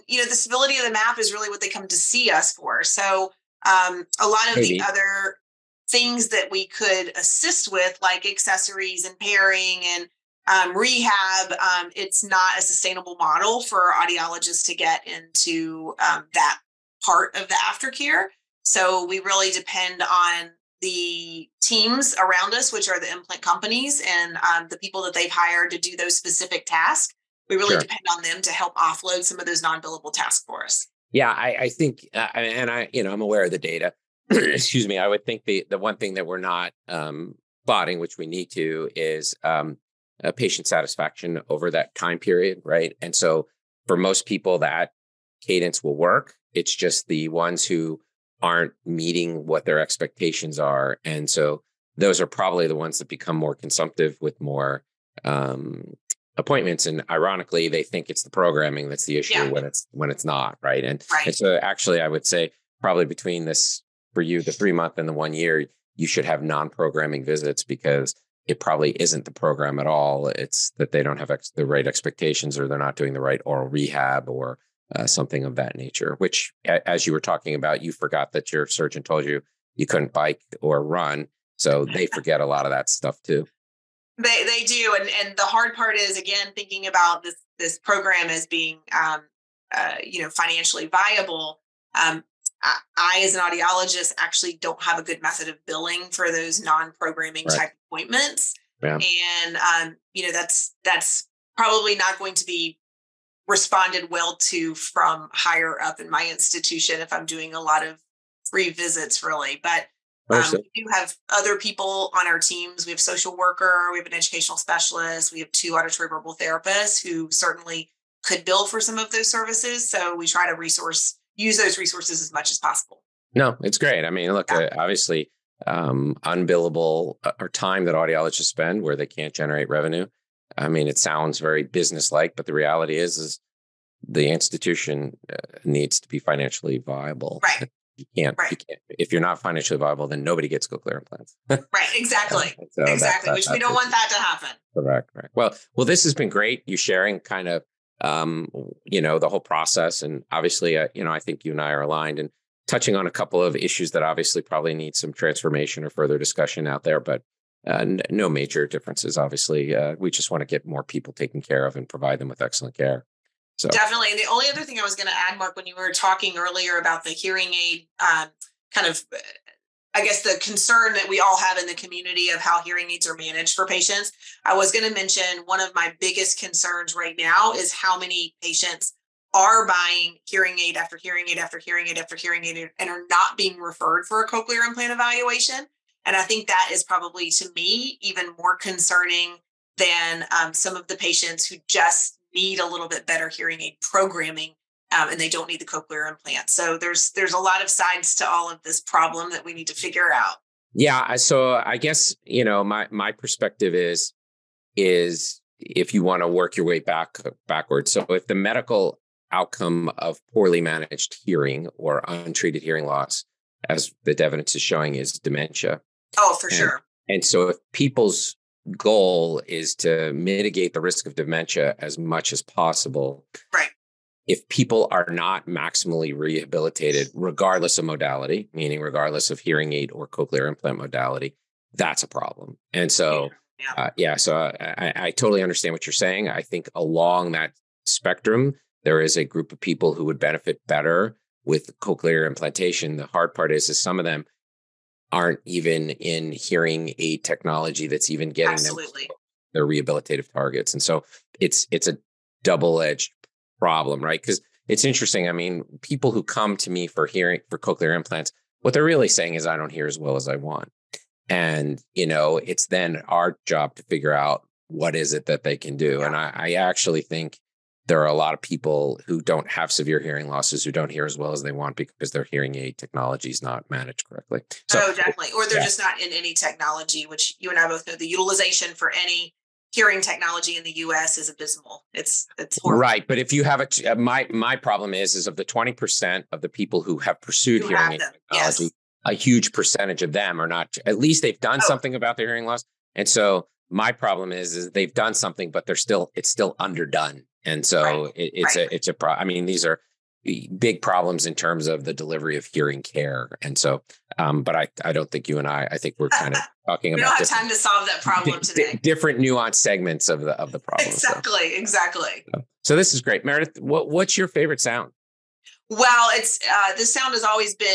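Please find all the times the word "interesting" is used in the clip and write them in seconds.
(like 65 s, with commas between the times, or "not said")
254 s.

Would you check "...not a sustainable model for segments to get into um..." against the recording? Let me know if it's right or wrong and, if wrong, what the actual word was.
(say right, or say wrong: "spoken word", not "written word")
wrong: "audiologists", not "segments".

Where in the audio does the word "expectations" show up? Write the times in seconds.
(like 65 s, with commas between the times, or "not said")
49 s, 71 s.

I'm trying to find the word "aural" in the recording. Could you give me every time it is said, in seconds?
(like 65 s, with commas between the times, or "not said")
73 s.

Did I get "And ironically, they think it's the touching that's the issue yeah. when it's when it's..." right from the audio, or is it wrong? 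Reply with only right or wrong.
wrong.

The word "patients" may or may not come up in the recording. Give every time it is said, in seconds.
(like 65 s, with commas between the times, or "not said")
40 s, 173 s, 178 s, 190 s.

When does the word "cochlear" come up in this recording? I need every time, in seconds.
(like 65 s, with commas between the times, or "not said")
184 s, 195 s, 230 s, 241 s, 257 s.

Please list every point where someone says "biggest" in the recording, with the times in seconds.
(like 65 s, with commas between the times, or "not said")
175 s.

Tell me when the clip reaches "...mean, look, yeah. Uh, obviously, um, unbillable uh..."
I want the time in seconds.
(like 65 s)
124 s.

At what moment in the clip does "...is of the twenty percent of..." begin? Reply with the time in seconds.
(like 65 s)
285 s.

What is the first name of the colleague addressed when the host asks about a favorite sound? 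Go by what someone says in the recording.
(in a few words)
Meredith.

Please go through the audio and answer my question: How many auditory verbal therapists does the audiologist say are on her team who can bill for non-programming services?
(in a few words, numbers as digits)
2.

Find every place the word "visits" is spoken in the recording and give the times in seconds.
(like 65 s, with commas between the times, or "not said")
67 s, 108 s.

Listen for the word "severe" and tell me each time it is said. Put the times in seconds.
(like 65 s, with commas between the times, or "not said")
269 s.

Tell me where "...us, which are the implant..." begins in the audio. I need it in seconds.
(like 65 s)
22 s.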